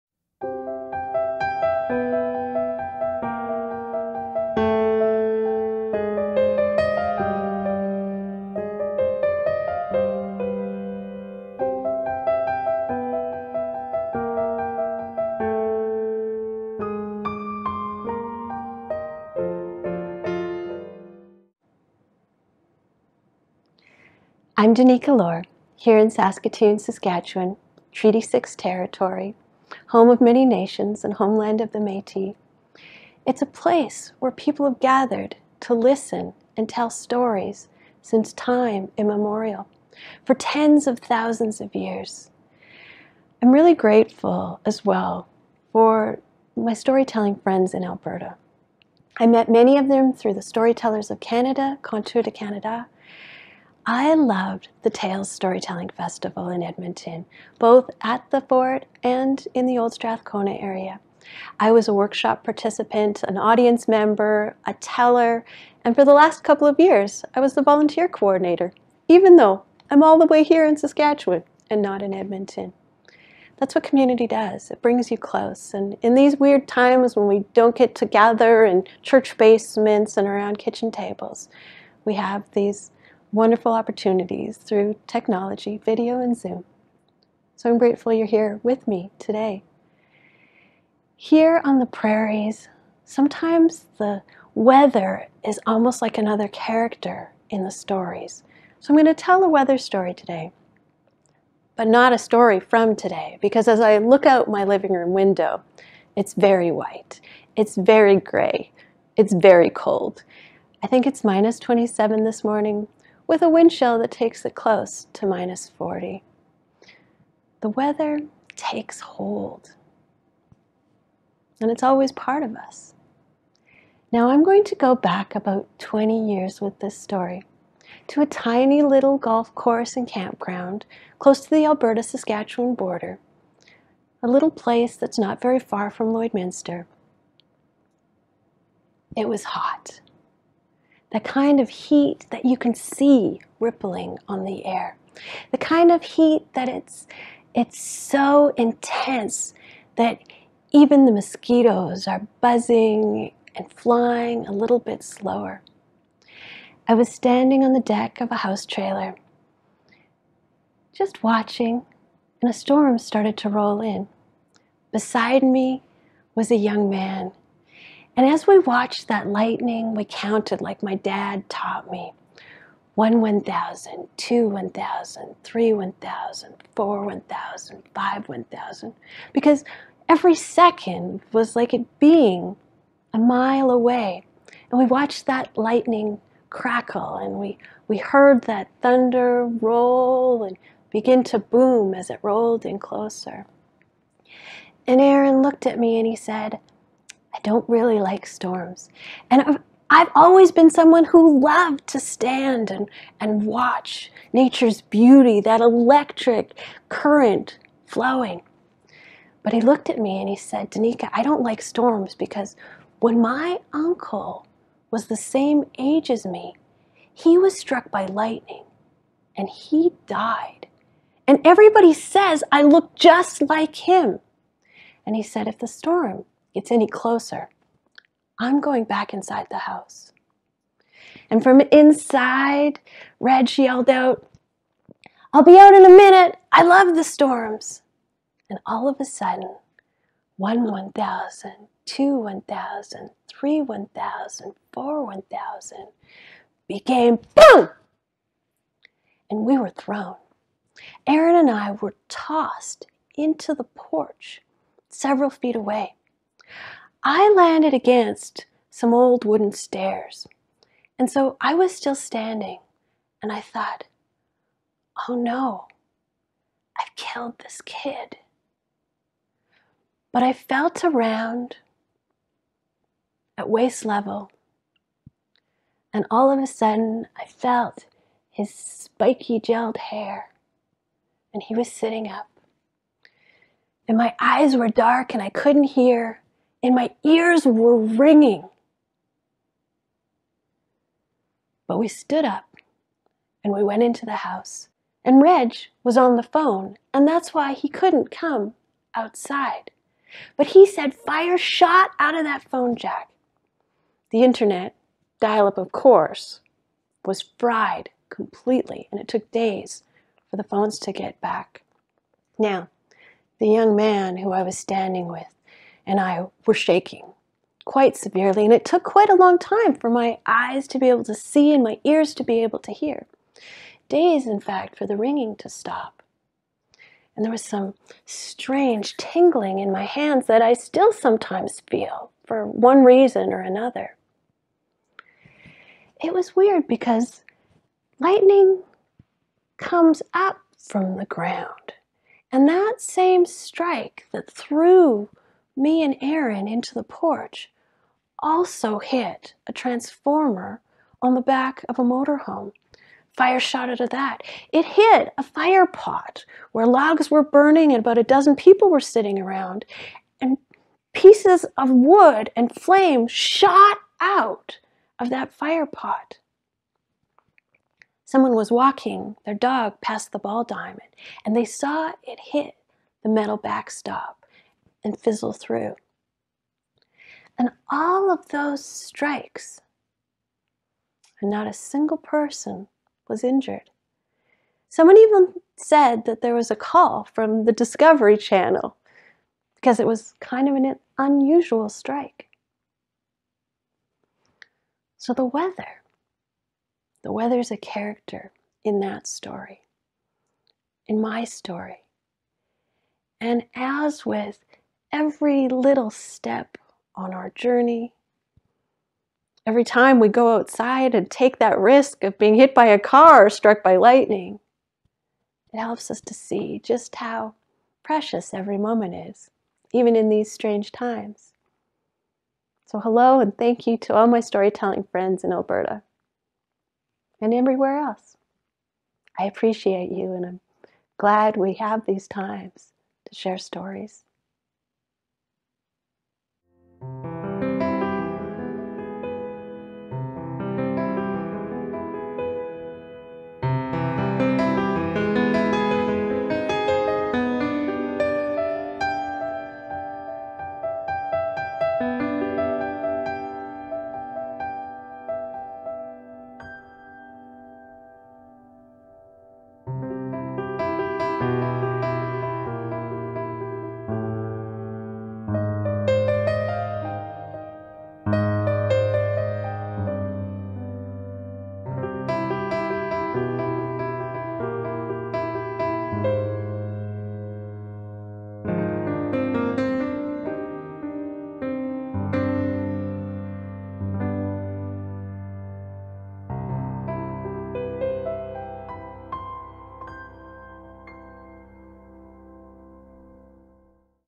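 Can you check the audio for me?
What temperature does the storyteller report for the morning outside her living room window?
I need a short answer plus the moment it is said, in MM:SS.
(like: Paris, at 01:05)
-27, at 01:51.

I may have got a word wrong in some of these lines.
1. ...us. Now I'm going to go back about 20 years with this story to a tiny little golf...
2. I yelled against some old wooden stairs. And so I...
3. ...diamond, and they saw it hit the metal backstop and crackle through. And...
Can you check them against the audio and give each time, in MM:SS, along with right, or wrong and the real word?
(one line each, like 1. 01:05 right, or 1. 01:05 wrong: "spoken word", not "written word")
1. 02:02 right
2. 04:17 wrong: "landed", not "yelled"
3. 06:10 wrong: "fizzle", not "crackle".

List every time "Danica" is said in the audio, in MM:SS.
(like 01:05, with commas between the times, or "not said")
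00:24, 03:30.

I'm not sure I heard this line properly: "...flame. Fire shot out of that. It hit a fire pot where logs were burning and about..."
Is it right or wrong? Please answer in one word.
wrong.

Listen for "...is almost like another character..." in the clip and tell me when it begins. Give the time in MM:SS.
01:35.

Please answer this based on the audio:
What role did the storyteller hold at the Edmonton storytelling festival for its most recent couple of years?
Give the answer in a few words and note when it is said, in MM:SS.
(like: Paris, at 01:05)
volunteer coordinator, at 01:07.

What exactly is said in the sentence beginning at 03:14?
And Aaron looked at me and he said, don't really like storms.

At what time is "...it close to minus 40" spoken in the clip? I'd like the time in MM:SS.
01:54.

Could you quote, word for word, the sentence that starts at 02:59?
Because every second was like it being a mile away.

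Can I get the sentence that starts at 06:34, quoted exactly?
So the weather, the weather is a character in that story, in my story.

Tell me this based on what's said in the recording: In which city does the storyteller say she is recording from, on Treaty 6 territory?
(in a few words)
Saskatoon.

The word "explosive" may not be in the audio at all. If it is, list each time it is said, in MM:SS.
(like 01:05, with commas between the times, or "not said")
not said.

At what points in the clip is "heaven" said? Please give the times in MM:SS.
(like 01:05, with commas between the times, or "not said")
not said.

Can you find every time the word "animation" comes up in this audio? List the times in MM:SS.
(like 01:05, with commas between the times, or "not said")
not said.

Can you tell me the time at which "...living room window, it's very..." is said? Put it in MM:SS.
01:44.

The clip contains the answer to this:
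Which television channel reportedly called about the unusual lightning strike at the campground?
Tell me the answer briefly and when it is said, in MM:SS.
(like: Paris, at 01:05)
Discovery Channel, at 06:27.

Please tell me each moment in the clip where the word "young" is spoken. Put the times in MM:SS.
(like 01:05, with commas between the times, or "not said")
02:46, 05:13.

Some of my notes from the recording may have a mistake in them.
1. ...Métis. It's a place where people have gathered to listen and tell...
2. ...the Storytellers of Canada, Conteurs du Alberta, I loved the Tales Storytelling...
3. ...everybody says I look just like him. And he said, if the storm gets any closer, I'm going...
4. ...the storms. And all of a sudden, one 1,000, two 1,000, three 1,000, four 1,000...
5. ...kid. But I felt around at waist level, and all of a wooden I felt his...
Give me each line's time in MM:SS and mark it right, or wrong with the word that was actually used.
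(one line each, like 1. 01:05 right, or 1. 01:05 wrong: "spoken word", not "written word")
1. 00:31 right
2. 00:50 wrong: "Canada", not "Alberta"
3. 03:41 right
4. 03:56 right
5. 04:27 wrong: "sudden", not "wooden".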